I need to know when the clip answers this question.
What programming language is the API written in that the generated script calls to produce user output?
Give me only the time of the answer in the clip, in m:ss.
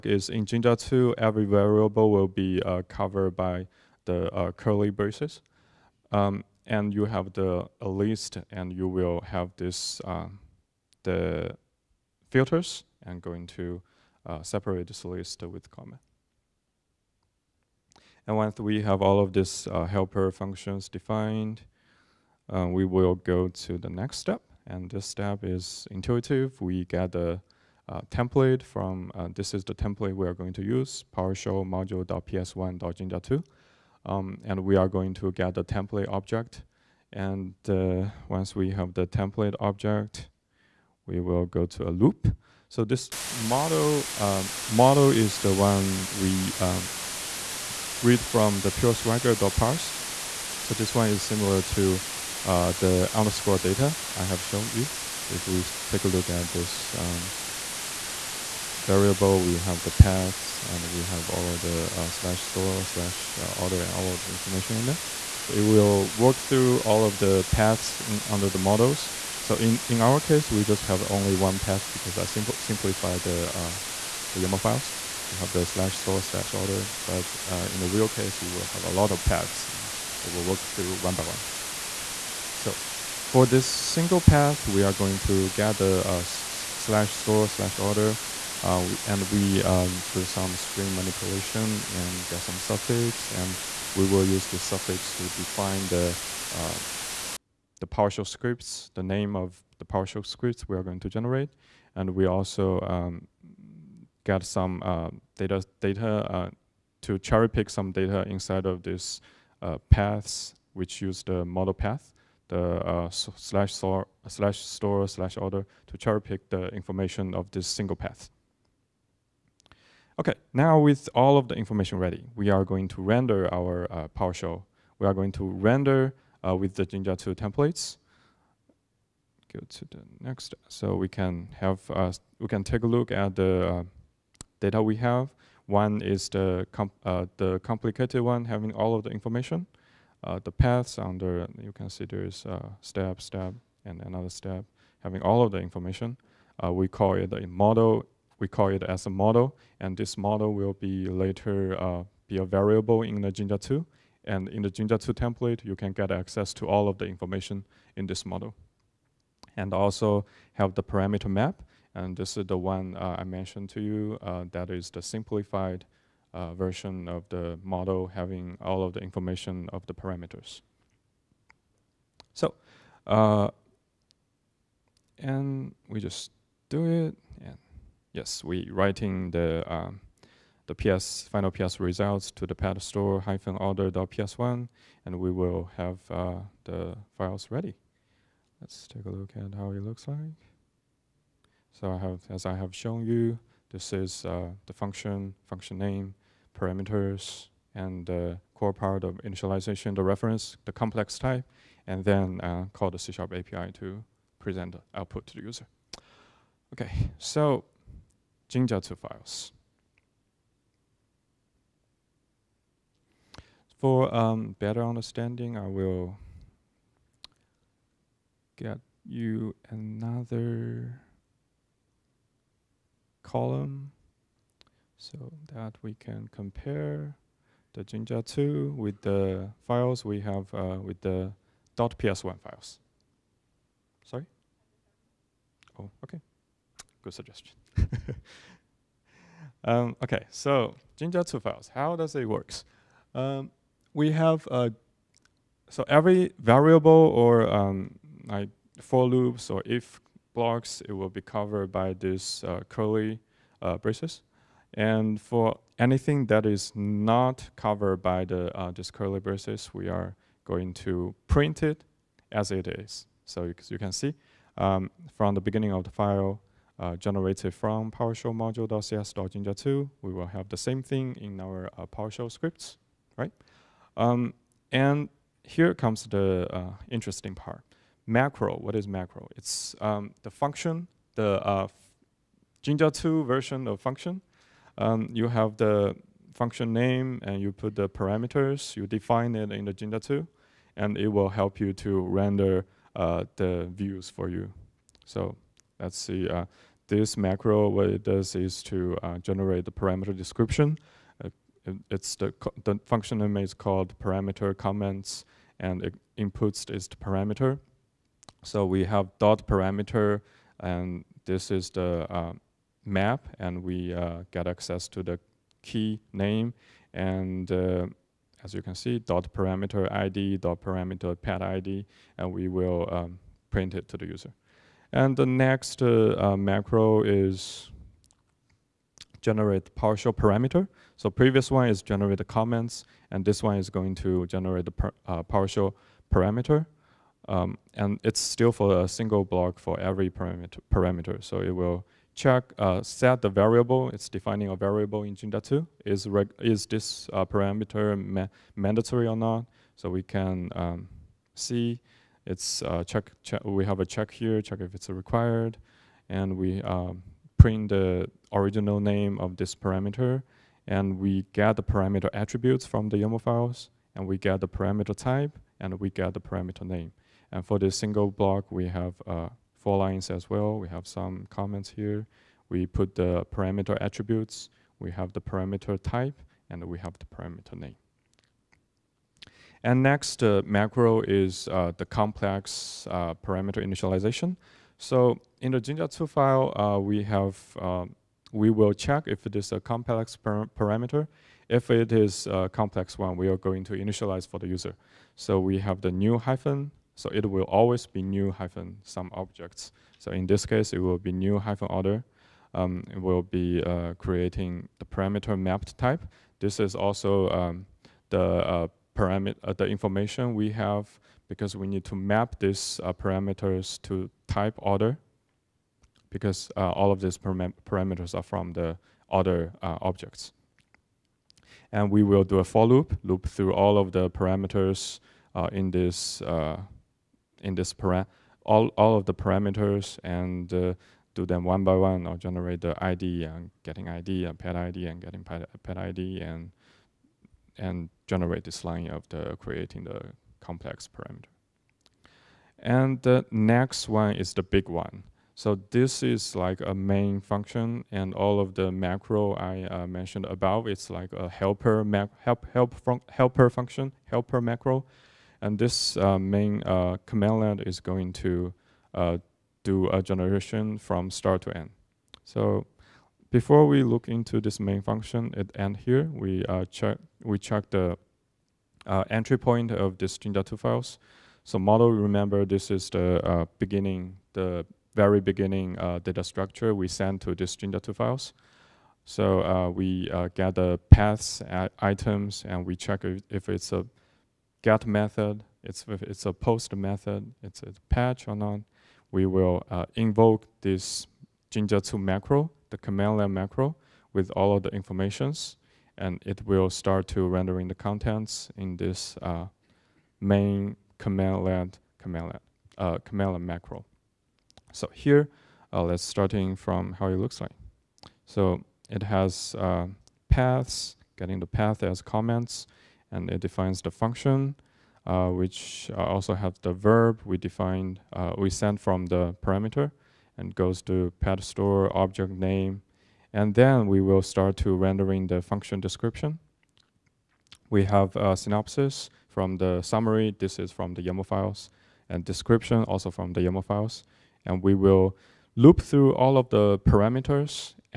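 3:22.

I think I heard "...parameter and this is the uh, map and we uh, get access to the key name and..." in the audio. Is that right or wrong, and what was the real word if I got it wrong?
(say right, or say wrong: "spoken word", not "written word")
right.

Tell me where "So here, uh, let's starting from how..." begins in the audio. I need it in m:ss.
8:24.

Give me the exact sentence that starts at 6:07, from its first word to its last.
And for this single block, we have uh, four lines as well.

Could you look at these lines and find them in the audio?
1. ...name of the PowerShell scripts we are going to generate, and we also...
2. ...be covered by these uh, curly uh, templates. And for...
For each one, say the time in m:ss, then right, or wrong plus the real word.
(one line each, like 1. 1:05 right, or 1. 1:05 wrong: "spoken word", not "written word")
1. 1:39 right
2. 4:11 wrong: "braces", not "templates".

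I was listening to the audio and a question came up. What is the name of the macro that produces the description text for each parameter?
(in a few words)
parameter comments.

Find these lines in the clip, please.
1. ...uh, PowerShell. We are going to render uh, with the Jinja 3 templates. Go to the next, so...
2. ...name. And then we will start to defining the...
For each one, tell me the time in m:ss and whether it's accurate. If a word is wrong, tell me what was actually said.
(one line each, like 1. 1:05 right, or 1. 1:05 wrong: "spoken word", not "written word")
1. 2:03 wrong: "2", not "3"
2. 8:42 wrong: "rendering", not "defining".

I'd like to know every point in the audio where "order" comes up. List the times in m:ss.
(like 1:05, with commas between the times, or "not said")
1:03, 1:16, 1:27, 1:55, 6:41, 6:54.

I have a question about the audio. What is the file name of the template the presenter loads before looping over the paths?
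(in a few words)
PowerShell module.ps1.jinja2.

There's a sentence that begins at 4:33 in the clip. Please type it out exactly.
Um, and here comes the uh, interesting part.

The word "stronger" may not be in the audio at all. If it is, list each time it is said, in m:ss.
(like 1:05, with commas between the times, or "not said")
not said.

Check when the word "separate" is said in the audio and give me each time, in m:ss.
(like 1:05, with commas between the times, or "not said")
0:14.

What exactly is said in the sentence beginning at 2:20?
Uh, the paths under you can see there's step, step, and another step, having all of the information.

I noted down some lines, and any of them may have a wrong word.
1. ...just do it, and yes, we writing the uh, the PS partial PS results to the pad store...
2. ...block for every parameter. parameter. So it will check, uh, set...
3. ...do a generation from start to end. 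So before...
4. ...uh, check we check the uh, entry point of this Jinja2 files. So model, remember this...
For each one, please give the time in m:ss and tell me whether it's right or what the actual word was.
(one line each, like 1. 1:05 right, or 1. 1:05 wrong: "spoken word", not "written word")
1. 2:56 wrong: "final", not "partial"
2. 5:39 right
3. 7:39 right
4. 7:46 right.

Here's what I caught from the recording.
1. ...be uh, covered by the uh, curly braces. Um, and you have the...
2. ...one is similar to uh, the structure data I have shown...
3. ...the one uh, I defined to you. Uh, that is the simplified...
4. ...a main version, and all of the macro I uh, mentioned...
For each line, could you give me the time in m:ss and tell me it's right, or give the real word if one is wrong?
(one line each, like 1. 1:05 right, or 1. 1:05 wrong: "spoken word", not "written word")
1. 0:02 right
2. 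0:50 wrong: "underscore", not "structure"
3. 2:42 wrong: "mentioned", not "defined"
4. 7:26 wrong: "function", not "version".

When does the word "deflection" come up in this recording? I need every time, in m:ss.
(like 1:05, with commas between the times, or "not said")
not said.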